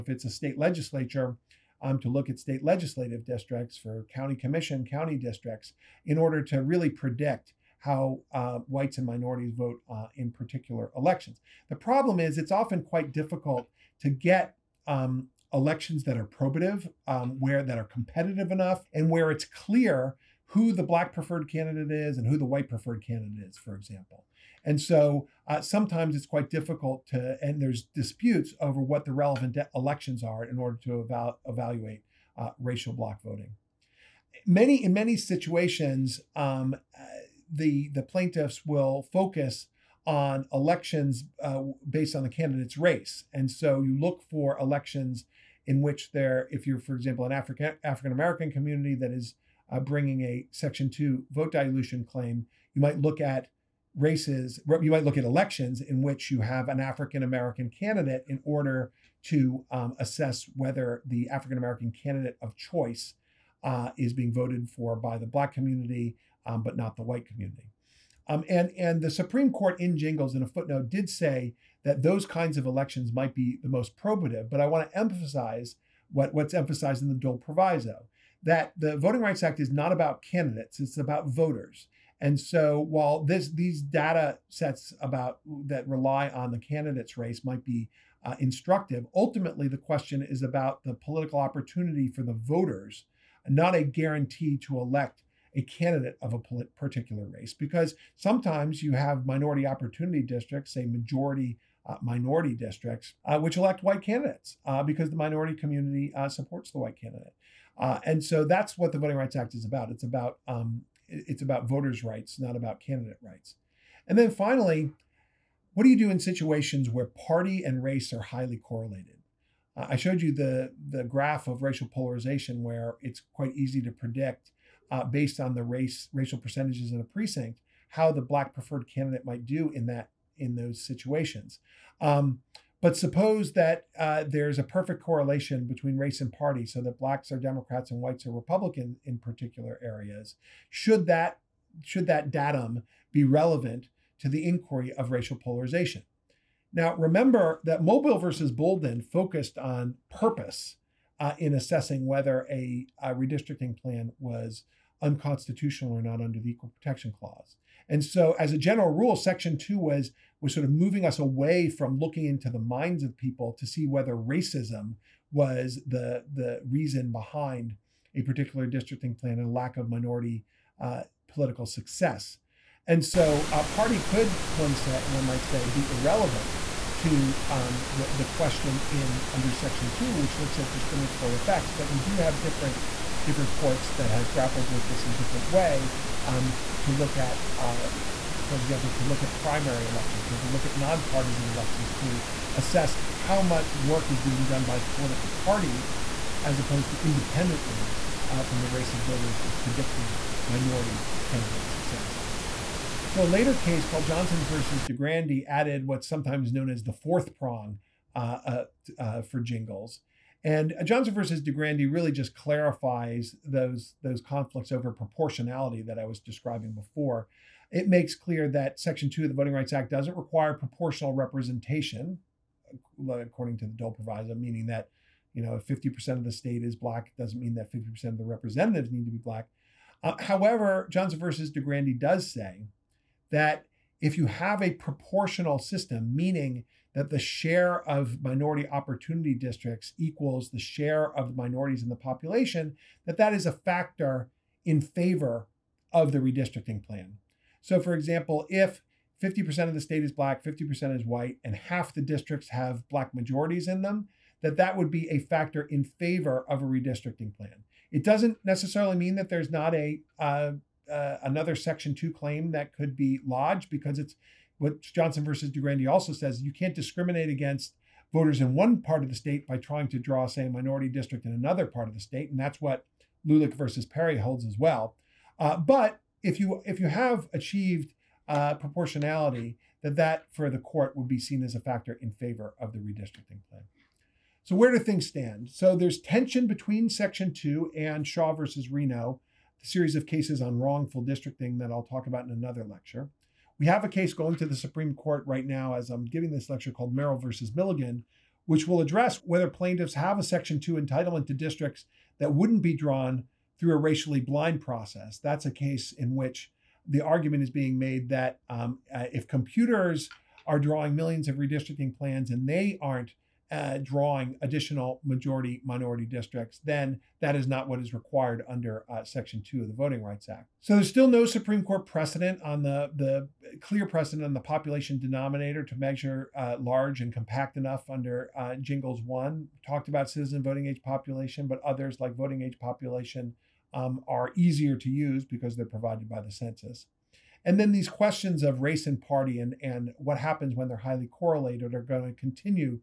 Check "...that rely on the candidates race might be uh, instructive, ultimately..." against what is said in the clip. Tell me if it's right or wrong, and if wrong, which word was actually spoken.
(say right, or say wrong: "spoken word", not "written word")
right.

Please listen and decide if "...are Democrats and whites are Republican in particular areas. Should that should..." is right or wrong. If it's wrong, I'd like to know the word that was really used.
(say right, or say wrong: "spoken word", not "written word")
right.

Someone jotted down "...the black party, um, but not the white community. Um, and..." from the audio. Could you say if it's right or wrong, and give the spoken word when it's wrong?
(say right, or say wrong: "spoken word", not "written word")
wrong: "community", not "party".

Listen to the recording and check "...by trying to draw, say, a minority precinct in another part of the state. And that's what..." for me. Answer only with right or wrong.
wrong.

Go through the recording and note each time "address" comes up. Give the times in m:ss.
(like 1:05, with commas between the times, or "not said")
4:58.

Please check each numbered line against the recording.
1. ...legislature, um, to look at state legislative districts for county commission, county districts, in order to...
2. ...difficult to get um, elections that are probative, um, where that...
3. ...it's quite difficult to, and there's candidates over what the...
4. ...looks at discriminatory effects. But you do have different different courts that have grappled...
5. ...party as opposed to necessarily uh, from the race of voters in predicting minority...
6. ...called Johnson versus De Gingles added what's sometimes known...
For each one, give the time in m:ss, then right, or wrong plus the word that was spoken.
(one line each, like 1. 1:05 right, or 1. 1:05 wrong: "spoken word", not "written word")
1. 0:00 right
2. 0:13 right
3. 0:26 wrong: "disputes", not "candidates"
4. 3:00 right
5. 3:15 wrong: "independently", not "necessarily"
6. 3:23 wrong: "Grandy", not "Gingles".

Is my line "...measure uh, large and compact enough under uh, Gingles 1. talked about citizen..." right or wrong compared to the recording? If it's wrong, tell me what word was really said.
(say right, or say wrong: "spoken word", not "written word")
right.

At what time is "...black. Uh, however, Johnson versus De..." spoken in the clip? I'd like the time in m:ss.
3:49.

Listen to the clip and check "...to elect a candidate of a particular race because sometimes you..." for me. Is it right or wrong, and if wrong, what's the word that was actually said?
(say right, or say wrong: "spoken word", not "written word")
right.